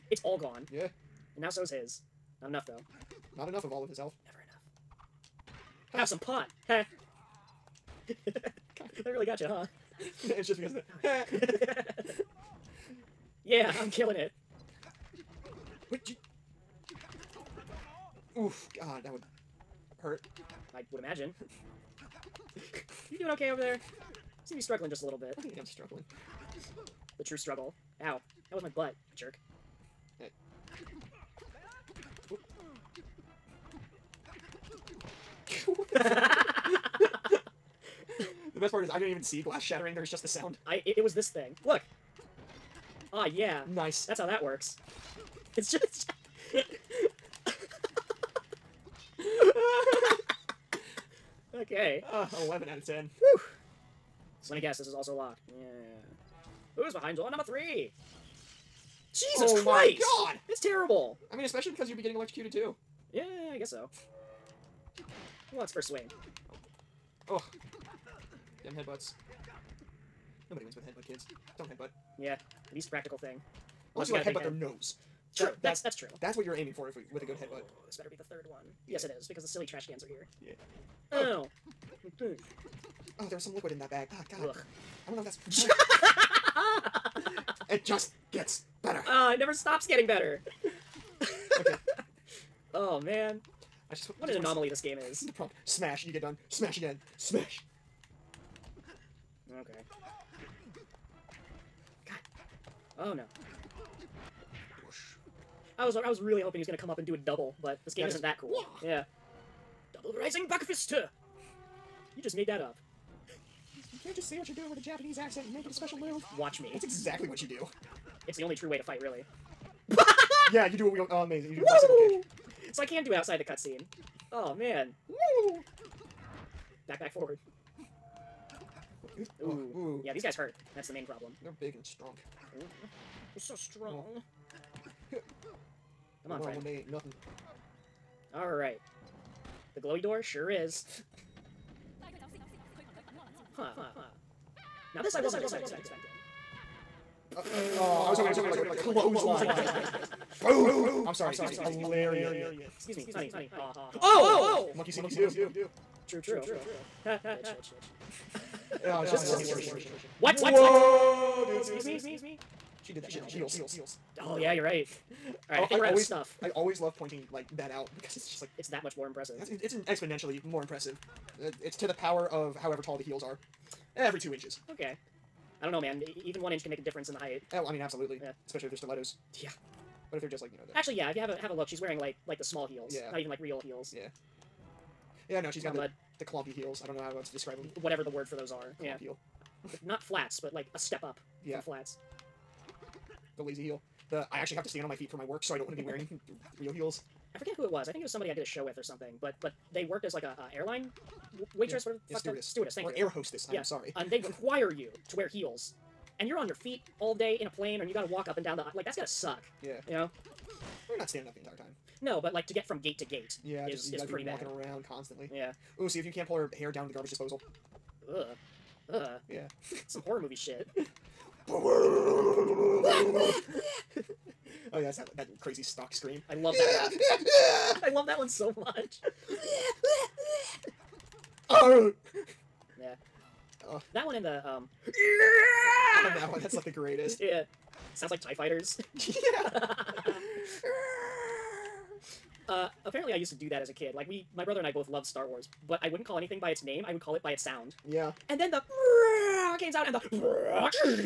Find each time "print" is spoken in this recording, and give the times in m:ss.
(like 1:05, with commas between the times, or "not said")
not said.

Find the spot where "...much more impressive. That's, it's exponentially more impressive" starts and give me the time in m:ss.
2:48.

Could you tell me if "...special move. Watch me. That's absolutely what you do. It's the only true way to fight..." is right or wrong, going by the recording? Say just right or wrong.
wrong.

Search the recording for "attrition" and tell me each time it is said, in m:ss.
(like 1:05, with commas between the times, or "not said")
2:39.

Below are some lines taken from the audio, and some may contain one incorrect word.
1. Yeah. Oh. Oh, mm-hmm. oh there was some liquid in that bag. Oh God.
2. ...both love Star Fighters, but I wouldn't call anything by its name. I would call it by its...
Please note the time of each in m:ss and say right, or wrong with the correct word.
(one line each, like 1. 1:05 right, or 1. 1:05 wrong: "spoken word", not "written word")
1. 1:20 right
2. 4:04 wrong: "Wars", not "Fighters".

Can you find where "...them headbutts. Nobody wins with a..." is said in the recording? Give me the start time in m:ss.
1:08.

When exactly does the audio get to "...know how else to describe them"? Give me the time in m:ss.
3:06.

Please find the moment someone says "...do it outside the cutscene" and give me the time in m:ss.
2:03.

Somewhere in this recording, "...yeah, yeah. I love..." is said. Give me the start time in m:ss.
3:46.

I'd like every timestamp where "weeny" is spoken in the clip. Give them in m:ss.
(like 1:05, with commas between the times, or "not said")
not said.